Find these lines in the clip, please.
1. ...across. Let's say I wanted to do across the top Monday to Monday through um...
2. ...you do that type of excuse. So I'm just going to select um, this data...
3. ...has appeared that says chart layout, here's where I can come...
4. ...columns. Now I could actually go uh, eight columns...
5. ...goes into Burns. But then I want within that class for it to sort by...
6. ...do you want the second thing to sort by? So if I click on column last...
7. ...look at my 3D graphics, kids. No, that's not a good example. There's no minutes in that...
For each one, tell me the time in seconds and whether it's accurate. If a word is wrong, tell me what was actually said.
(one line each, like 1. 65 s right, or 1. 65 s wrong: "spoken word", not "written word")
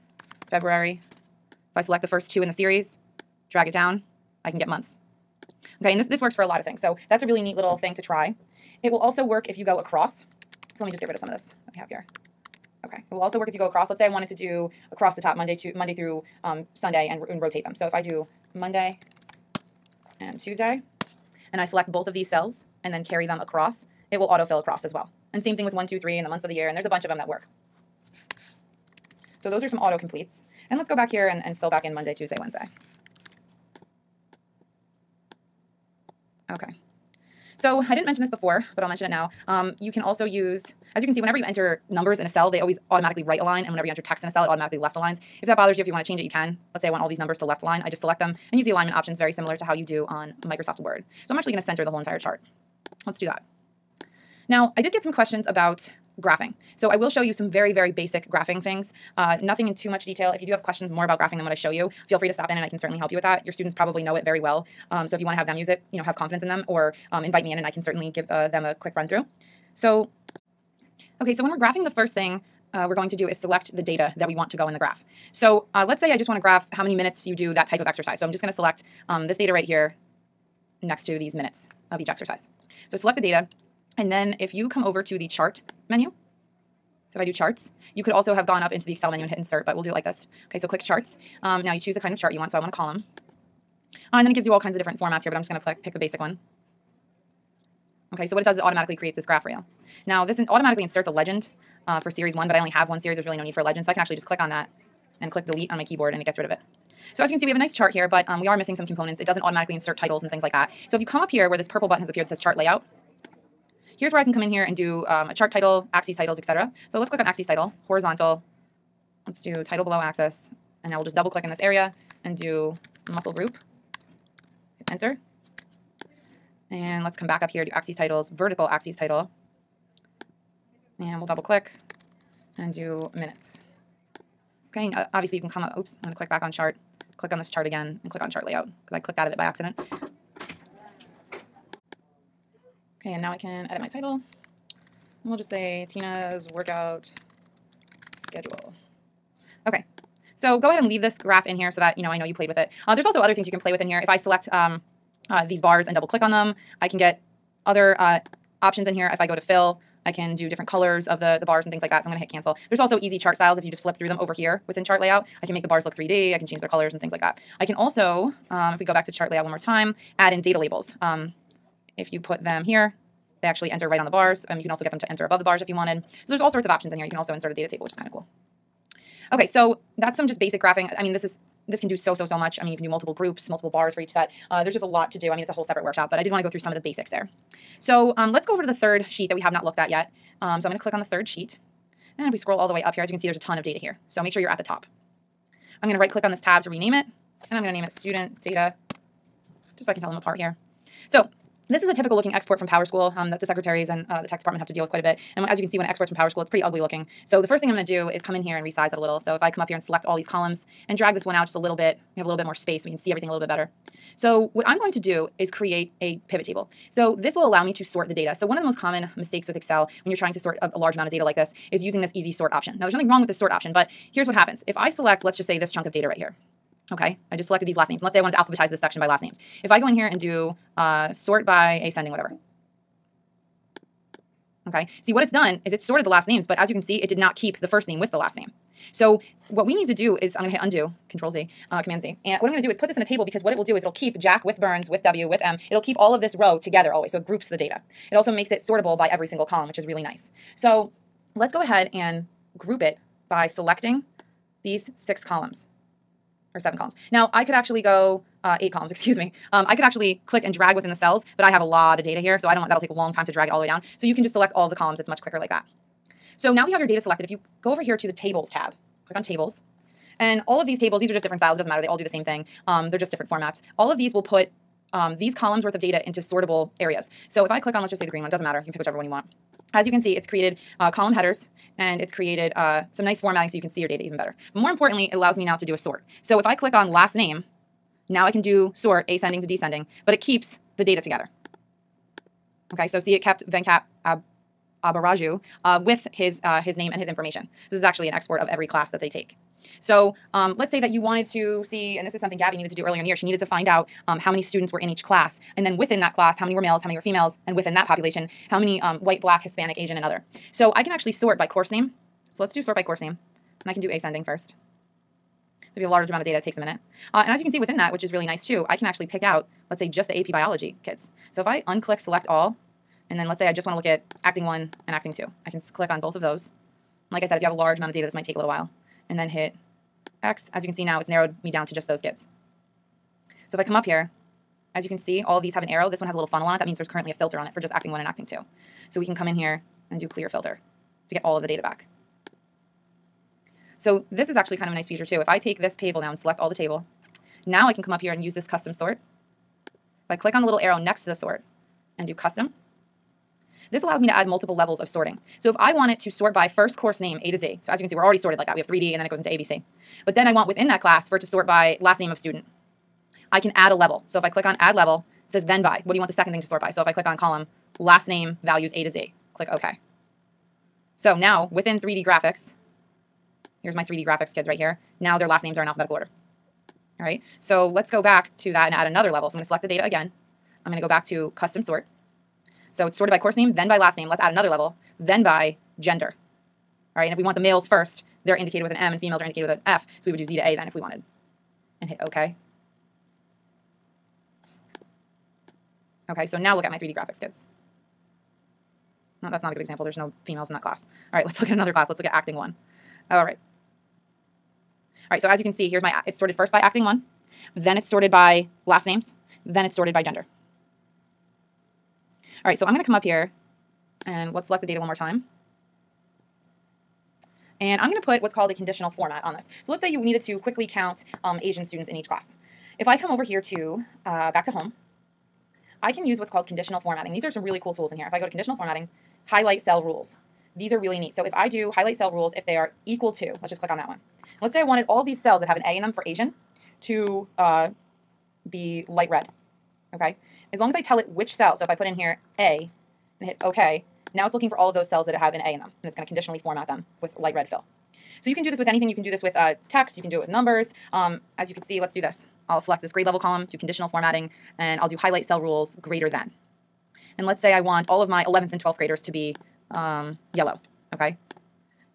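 1. 13 s right
2. 77 s wrong: "exercise", not "excuse"
3. 112 s right
4. 256 s right
5. 359 s wrong: "ABC", not "Burns"
6. 365 s right
7. 396 s wrong: "females", not "minutes".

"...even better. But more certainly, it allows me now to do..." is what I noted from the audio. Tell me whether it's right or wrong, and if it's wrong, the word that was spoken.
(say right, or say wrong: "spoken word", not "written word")
wrong: "importantly", not "certainly".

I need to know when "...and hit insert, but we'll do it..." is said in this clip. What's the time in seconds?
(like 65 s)
89 s.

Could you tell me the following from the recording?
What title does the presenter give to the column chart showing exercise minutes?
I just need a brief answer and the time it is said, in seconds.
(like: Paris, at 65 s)
Tina's workout schedule, at 145 s.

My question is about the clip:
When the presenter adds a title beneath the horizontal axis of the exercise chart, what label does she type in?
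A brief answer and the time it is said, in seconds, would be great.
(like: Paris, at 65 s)
Muscle group, at 123 s.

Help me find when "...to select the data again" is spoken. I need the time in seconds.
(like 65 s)
379 s.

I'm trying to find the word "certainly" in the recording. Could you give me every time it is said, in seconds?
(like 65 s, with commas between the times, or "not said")
62 s, 67 s.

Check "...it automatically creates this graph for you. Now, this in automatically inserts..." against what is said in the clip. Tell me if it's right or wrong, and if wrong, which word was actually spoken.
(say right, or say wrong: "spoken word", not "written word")
right.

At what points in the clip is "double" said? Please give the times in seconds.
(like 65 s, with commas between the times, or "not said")
121 s, 131 s, 155 s.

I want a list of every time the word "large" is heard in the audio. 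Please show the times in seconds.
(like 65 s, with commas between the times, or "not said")
220 s, 315 s, 327 s.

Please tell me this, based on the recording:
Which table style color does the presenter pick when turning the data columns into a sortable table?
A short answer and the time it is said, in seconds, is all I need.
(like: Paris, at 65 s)
Green, at 278 s.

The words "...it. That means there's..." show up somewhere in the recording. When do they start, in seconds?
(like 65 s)
336 s.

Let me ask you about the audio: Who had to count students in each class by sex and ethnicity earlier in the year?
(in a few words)
Gabby.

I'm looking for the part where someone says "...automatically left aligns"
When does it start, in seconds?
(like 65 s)
44 s.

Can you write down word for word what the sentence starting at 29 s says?
So those are some auto completes.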